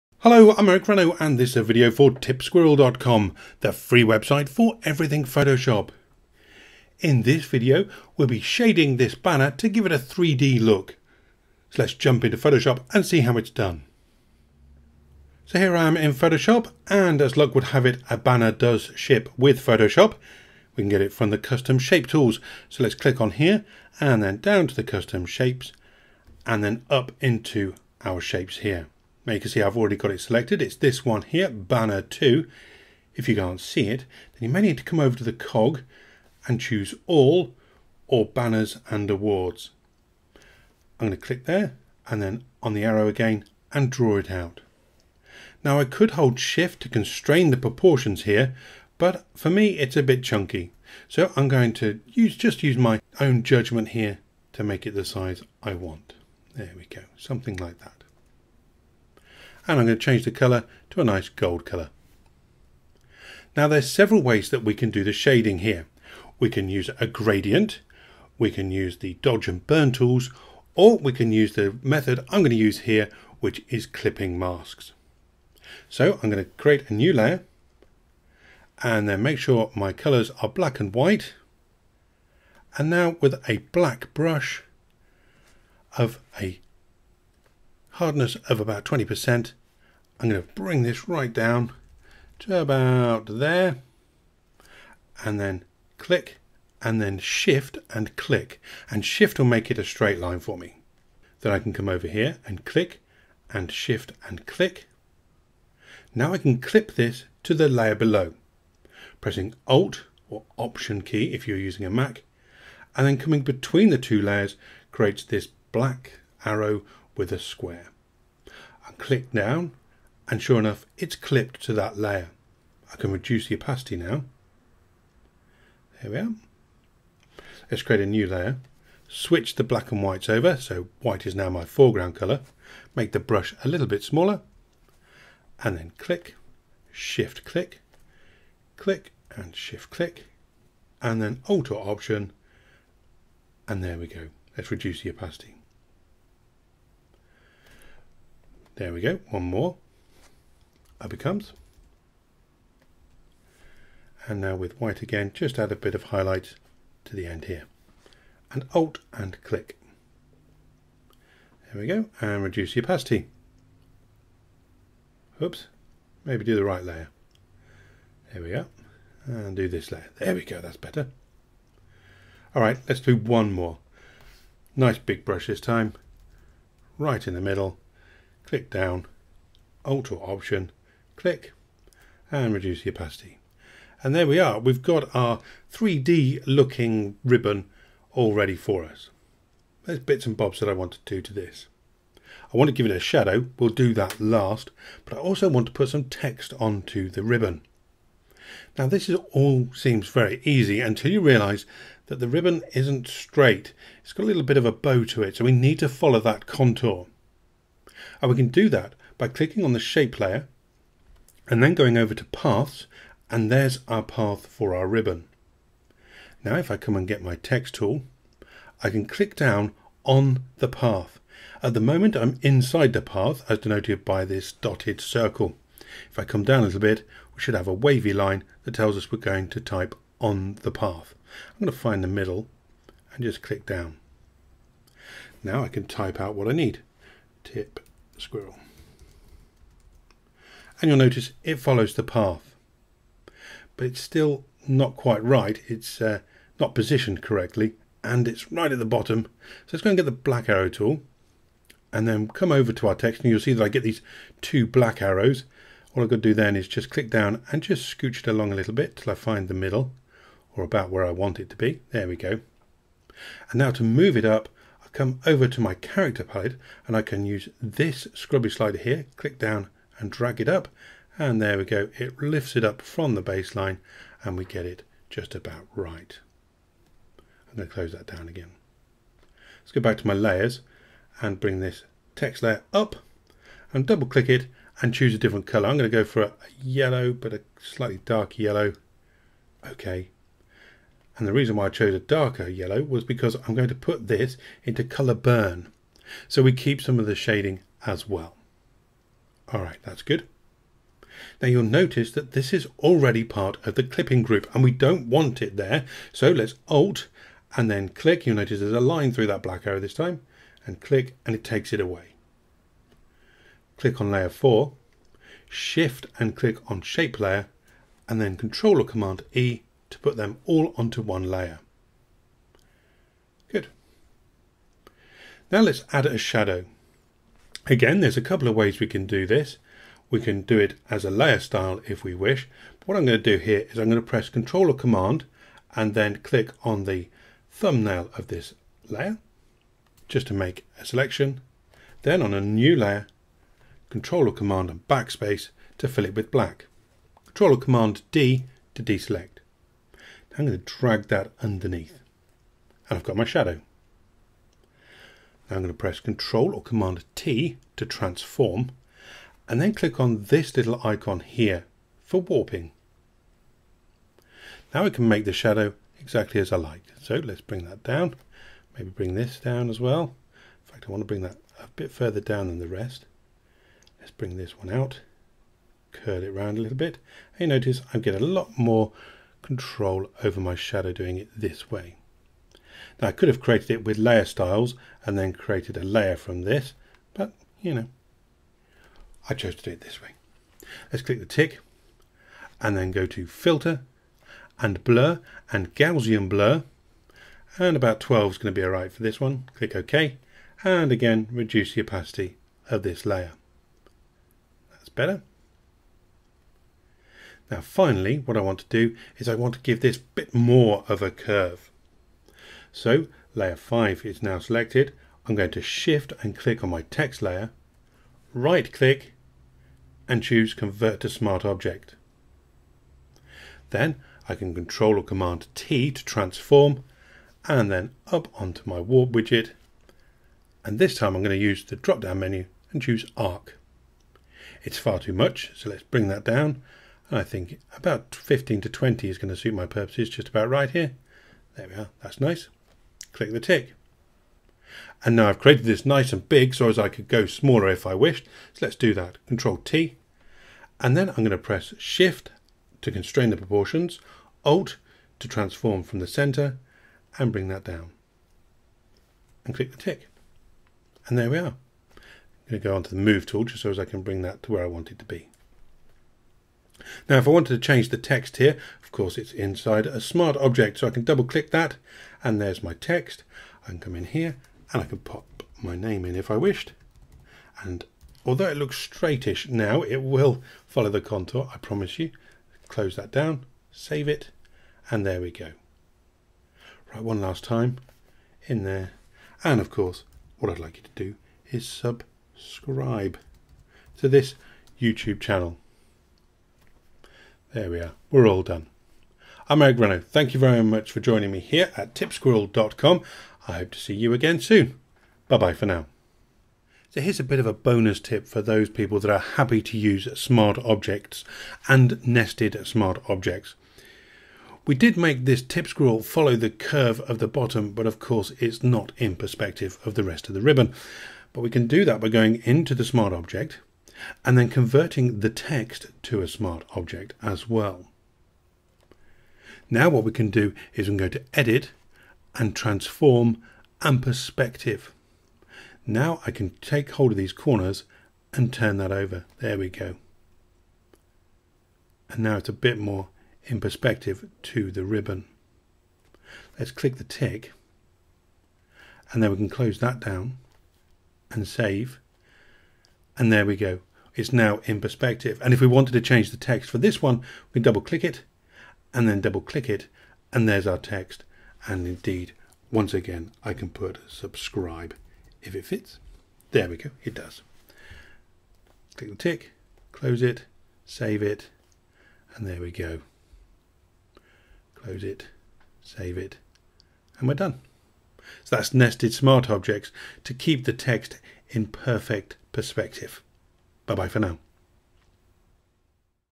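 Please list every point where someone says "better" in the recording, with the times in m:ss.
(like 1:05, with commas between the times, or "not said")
2:50, 6:44.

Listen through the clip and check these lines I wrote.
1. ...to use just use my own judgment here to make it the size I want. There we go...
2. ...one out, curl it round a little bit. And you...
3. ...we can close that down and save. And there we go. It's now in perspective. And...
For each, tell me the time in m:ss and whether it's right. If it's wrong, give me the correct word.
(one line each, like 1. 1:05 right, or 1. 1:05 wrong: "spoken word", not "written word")
1. 0:51 right
2. 6:14 right
3. 9:09 right.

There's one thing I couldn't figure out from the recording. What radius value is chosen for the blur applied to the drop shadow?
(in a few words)
12.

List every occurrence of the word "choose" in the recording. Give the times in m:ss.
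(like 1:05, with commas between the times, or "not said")
0:36, 4:44, 7:00, 7:12.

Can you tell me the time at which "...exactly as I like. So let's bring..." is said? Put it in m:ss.
6:05.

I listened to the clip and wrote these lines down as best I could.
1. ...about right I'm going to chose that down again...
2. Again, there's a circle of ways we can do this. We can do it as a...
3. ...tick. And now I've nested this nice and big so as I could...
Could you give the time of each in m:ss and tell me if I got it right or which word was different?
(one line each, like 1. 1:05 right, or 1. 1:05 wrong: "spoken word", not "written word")
1. 4:35 wrong: "close", not "chose"
2. 5:27 wrong: "couple", not "circle"
3. 7:23 wrong: "created", not "nested".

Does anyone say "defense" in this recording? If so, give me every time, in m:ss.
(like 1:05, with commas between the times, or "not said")
not said.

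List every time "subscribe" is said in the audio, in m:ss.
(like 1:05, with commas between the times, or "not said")
8:11, 9:24.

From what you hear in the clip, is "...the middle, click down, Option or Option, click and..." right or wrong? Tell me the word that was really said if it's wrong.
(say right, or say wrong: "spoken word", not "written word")
wrong: "Alt", not "Option".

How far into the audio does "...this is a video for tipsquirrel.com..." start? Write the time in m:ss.
0:01.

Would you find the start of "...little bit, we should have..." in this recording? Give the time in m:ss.
3:46.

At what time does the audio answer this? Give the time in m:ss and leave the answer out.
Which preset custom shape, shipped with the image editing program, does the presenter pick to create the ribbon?
0:31.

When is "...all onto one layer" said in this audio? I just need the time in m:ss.
5:20.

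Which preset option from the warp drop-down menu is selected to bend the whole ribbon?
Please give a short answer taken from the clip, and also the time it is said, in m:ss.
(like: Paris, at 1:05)
Arc, at 7:13.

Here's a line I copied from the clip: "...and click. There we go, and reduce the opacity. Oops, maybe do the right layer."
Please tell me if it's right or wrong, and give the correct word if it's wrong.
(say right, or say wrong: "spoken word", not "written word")
right.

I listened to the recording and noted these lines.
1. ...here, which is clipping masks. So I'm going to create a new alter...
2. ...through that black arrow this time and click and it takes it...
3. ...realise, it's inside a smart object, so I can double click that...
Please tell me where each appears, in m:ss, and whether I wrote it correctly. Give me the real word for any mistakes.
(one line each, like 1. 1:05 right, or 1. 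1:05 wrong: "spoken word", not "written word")
1. 1:12 wrong: "layer", not "alter"
2. 5:09 right
3. 7:48 wrong: "course", not "realise".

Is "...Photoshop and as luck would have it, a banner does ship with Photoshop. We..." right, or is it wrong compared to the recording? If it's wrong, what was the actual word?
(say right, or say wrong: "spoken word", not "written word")
right.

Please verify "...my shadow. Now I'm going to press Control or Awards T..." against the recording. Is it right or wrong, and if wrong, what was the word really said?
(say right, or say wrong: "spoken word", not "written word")
wrong: "Command", not "Awards".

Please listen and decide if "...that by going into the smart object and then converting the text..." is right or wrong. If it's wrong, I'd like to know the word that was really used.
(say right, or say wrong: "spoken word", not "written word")
right.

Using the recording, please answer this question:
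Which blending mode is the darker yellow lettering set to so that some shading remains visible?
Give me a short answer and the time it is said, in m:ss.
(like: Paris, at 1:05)
Color burn, at 4:54.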